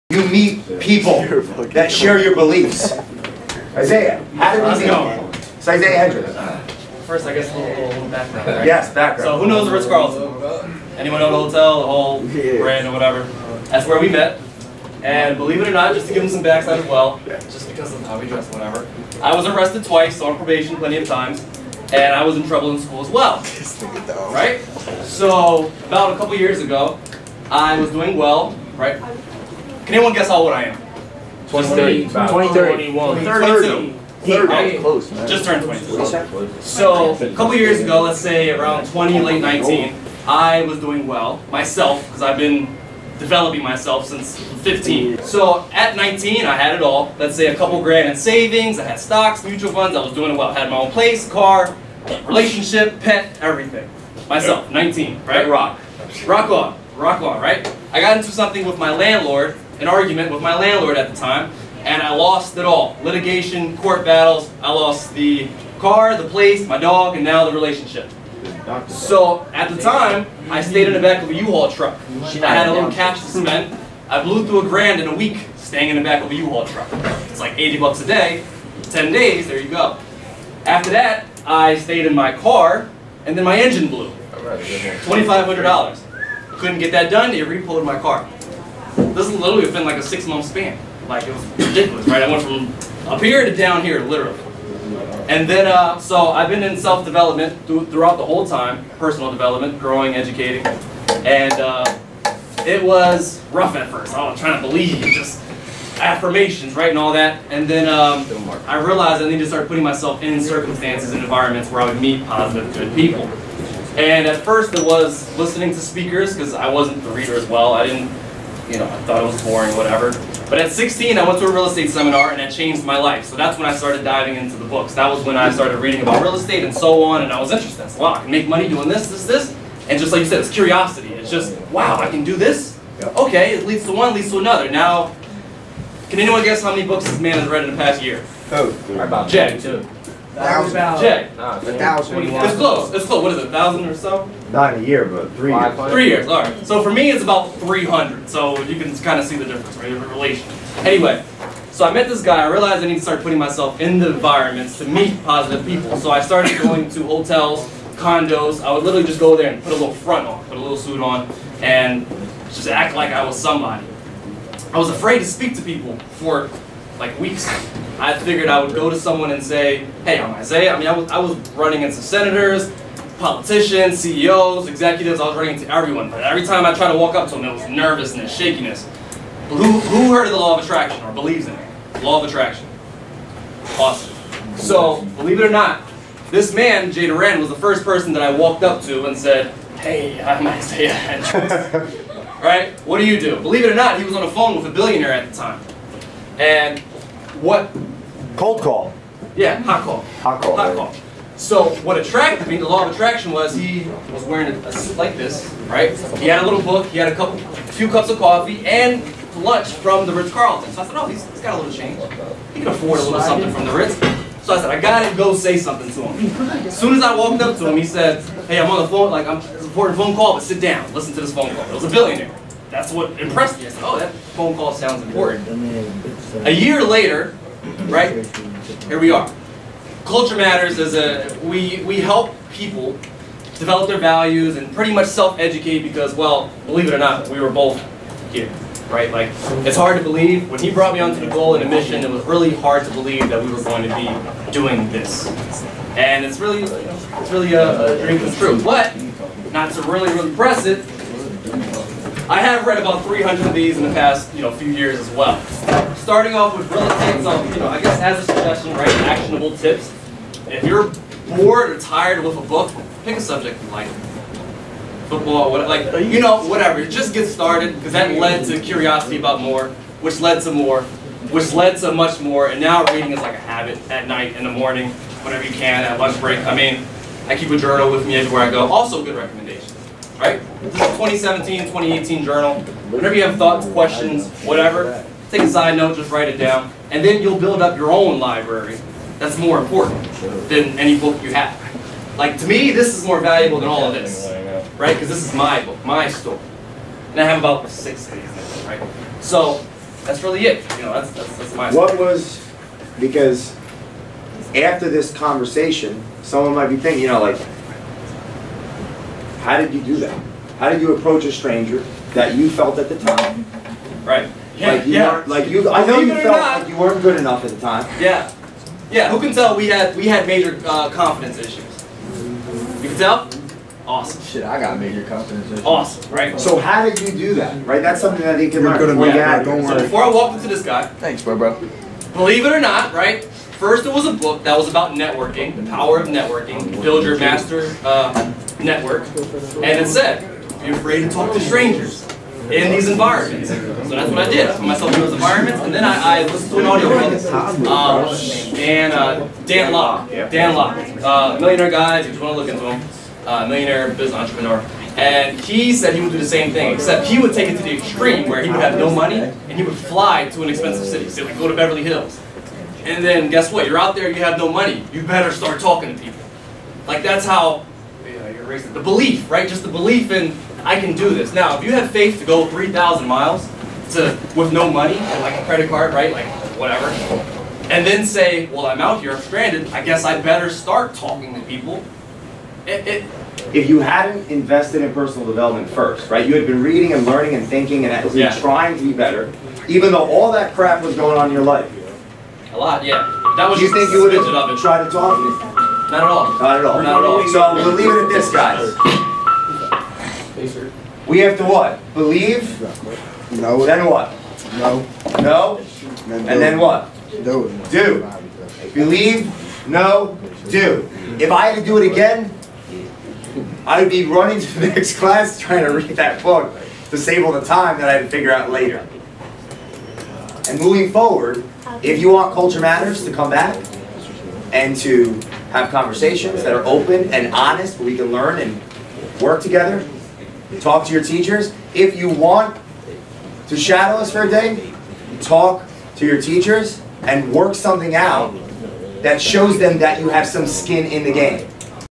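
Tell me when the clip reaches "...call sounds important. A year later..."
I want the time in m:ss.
3:44.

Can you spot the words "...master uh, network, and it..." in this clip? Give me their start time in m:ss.
5:37.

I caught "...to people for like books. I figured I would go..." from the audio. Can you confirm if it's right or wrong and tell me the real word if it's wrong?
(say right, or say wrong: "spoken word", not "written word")
wrong: "weeks", not "books".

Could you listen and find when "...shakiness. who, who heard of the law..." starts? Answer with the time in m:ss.
2:58.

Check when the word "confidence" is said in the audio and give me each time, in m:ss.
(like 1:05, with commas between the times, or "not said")
5:20, 5:25.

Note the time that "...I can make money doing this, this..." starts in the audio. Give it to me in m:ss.
2:08.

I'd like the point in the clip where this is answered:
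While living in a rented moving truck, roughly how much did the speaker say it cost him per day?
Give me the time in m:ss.
1:17.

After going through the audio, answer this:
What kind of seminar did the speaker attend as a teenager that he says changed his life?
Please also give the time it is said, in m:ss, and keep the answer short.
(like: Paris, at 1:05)
real estate seminar, at 2:01.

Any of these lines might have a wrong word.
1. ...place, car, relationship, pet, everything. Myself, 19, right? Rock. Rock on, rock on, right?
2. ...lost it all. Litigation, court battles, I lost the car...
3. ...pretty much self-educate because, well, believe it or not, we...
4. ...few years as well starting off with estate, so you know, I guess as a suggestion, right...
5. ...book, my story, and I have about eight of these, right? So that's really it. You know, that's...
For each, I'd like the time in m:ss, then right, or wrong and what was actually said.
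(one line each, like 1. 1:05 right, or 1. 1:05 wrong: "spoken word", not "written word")
1. 0:50 right
2. 1:02 right
3. 3:54 right
4. 4:14 right
5. 4:55 wrong: "six", not "eight".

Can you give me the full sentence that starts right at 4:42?
Whenever you have thoughts, questions, whatever, Take a side note, just write it down, and then you'll build up your own library.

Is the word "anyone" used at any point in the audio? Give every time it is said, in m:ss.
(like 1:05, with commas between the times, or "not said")
0:10, 0:29, 2:16.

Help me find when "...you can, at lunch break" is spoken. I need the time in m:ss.
4:35.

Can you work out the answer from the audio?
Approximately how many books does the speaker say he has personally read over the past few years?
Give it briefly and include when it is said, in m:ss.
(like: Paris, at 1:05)
300, at 2:27.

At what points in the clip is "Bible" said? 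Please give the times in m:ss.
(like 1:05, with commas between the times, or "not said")
not said.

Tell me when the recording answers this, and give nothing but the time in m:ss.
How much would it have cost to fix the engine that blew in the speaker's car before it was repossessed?
1:24.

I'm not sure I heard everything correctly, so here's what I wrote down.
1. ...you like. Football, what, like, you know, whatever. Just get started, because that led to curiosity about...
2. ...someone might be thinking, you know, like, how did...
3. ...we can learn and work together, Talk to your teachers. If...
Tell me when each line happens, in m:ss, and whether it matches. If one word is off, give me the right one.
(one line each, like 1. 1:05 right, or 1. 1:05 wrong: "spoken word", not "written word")
1. 4:23 right
2. 5:06 right
3. 7:07 right.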